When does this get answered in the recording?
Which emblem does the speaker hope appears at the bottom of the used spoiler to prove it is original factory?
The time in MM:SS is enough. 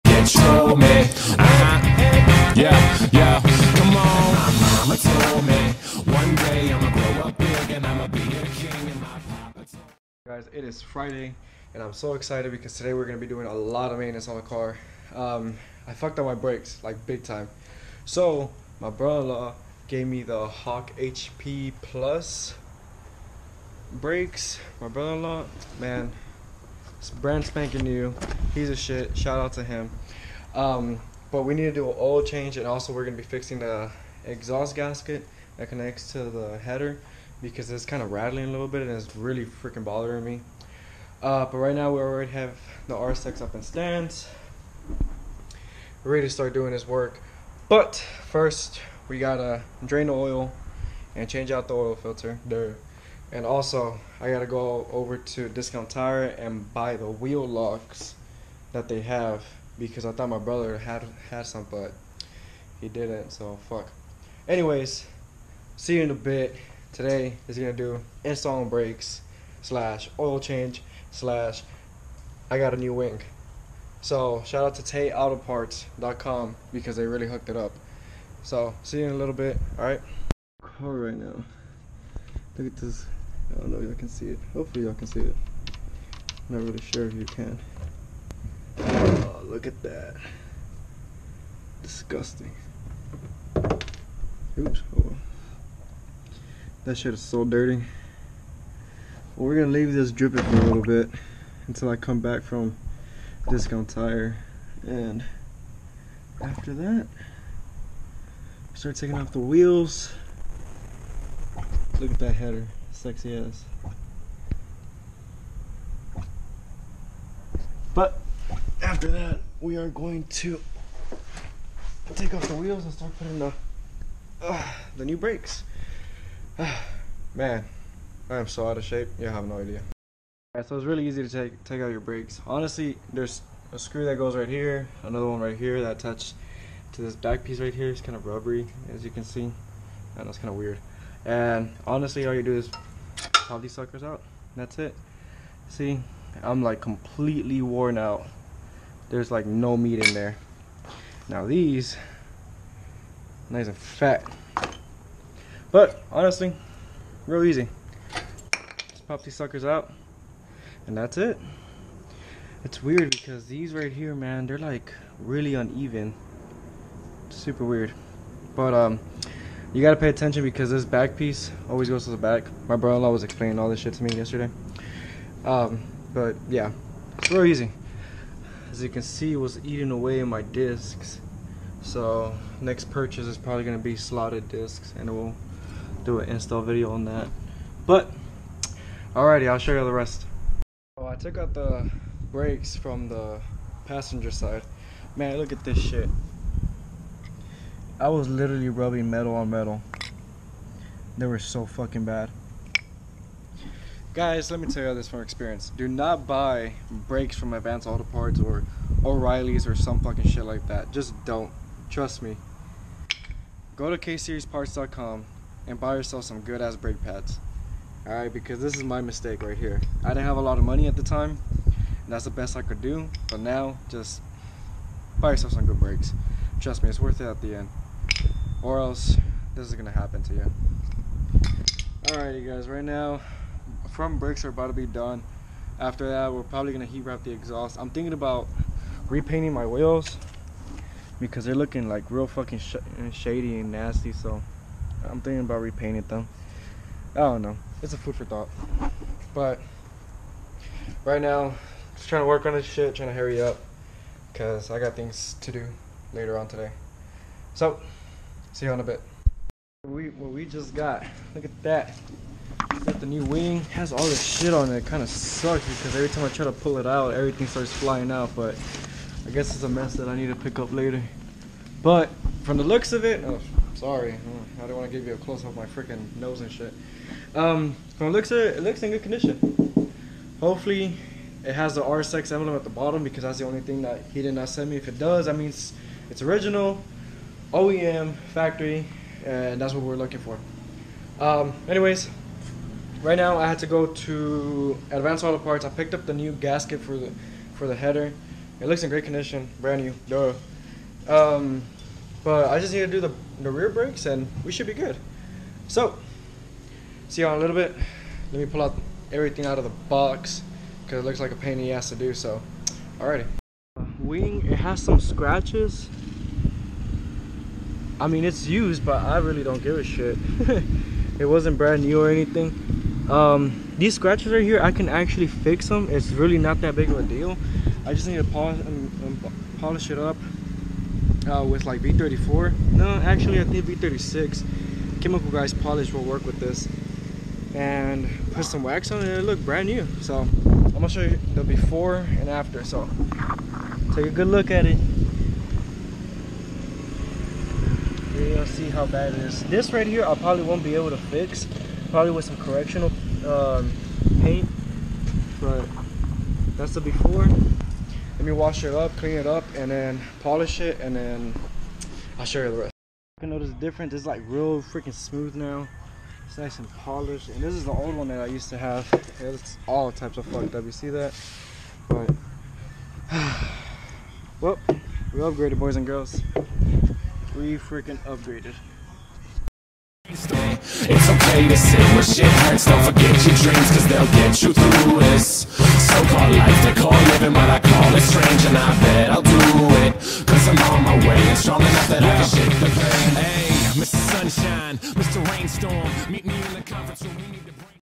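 04:41.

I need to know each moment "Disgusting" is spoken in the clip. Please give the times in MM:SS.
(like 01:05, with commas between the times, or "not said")
01:31.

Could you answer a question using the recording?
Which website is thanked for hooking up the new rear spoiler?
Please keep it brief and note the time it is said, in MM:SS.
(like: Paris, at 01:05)
TayAutoParts.com, at 01:14.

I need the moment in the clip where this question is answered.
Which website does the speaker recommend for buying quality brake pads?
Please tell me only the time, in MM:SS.
03:33.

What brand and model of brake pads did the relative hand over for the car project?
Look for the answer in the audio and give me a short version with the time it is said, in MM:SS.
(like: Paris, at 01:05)
Hawk HP Plus, at 00:20.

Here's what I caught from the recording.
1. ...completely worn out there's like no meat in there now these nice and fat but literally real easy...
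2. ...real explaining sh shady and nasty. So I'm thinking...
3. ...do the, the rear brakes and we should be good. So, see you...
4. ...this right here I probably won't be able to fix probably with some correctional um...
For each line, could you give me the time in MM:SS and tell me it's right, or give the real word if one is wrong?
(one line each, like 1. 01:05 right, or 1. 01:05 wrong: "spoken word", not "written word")
1. 02:26 wrong: "honestly", not "literally"
2. 04:02 wrong: "fucking", not "explaining"
3. 05:02 right
4. 05:49 right.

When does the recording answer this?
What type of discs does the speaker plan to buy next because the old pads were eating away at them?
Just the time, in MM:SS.
03:03.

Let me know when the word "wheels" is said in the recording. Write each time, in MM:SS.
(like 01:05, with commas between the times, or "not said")
00:57, 01:49, 02:02, 03:59.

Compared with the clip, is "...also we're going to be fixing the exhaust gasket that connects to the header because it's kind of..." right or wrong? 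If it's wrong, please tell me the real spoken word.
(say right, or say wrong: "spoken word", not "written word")
right.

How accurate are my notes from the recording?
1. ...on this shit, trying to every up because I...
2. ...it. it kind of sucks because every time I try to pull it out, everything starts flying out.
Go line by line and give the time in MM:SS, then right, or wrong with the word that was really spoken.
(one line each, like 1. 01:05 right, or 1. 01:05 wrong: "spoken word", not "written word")
1. 04:12 wrong: "hurry", not "every"
2. 04:24 right.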